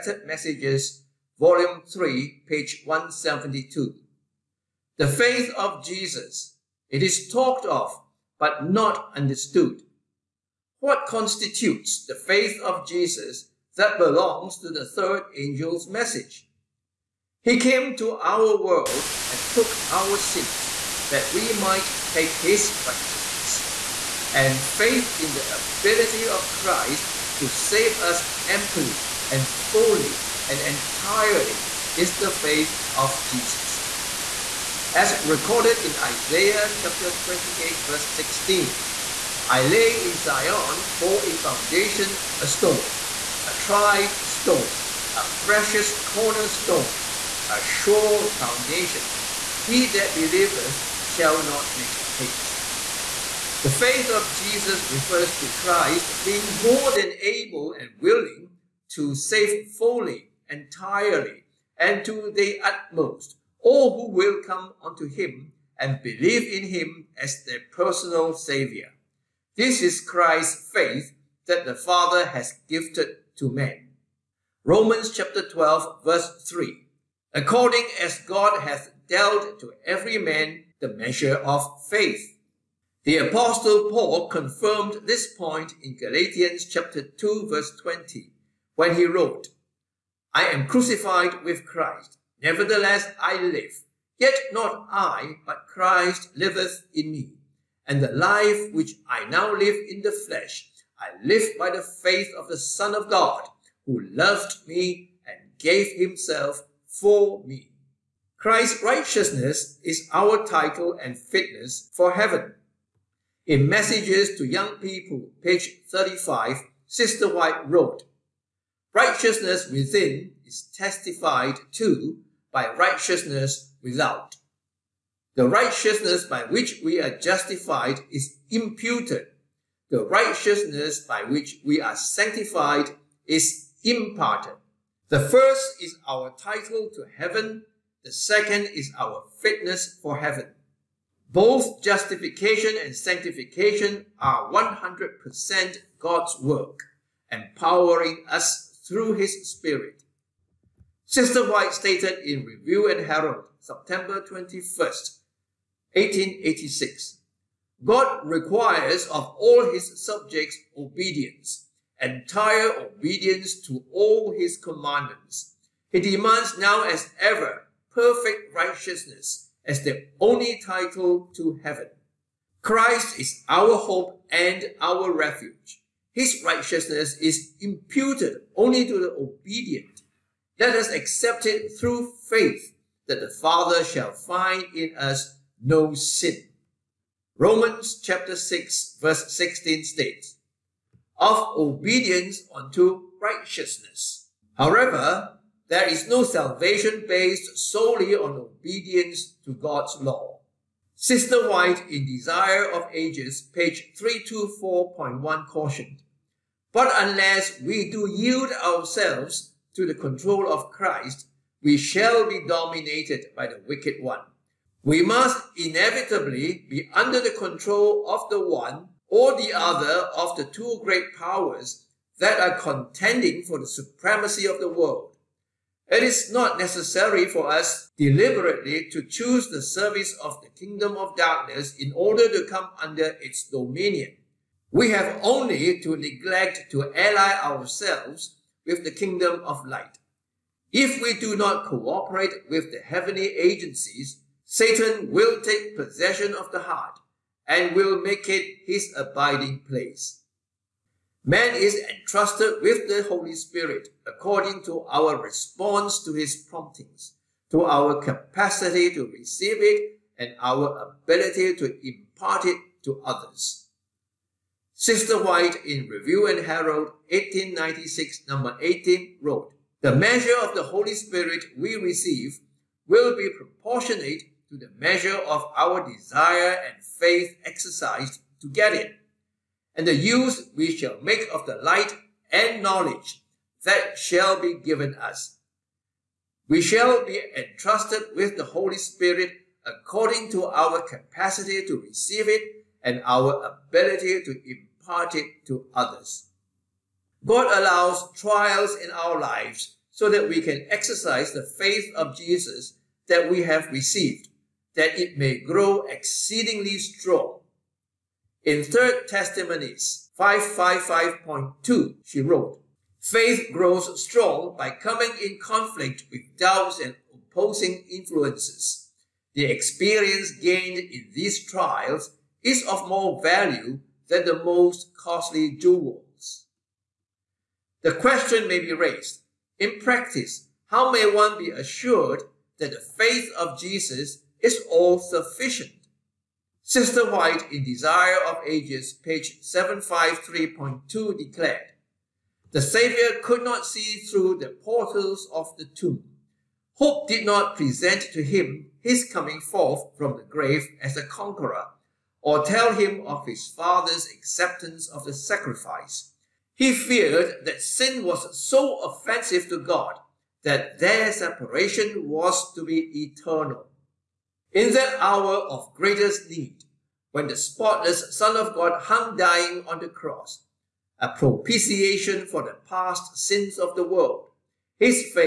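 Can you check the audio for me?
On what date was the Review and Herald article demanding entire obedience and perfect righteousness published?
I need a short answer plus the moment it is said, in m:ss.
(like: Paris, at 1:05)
September 21, 1886, at 2:33.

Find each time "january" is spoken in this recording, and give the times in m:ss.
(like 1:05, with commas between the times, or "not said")
not said.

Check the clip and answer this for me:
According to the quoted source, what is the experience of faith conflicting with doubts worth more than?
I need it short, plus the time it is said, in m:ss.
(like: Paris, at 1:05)
most costly jewels, at 5:24.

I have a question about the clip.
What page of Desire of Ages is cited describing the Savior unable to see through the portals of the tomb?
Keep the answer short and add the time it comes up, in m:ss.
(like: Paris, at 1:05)
753.2, at 5:39.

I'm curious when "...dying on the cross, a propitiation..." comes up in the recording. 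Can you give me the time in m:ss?
6:09.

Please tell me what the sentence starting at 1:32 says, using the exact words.
Nevertheless I live, yet not I, but Christ liveth in me.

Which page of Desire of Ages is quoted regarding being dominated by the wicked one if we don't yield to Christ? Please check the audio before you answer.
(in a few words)
324.1.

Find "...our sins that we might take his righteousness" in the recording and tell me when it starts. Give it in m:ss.
0:19.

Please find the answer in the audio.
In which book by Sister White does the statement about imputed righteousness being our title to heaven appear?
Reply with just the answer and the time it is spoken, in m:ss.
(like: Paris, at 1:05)
Messages to Young People, at 1:53.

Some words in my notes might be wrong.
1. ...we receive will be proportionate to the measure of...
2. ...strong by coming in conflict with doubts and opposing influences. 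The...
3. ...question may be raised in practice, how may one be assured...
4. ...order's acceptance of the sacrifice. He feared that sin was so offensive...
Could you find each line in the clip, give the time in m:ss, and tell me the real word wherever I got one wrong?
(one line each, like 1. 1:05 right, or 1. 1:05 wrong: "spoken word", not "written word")
1. 4:31 right
2. 5:14 right
3. 5:27 right
4. 5:53 wrong: "father", not "order".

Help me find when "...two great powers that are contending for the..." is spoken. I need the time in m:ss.
3:40.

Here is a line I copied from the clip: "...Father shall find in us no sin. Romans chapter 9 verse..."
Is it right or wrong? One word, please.
wrong.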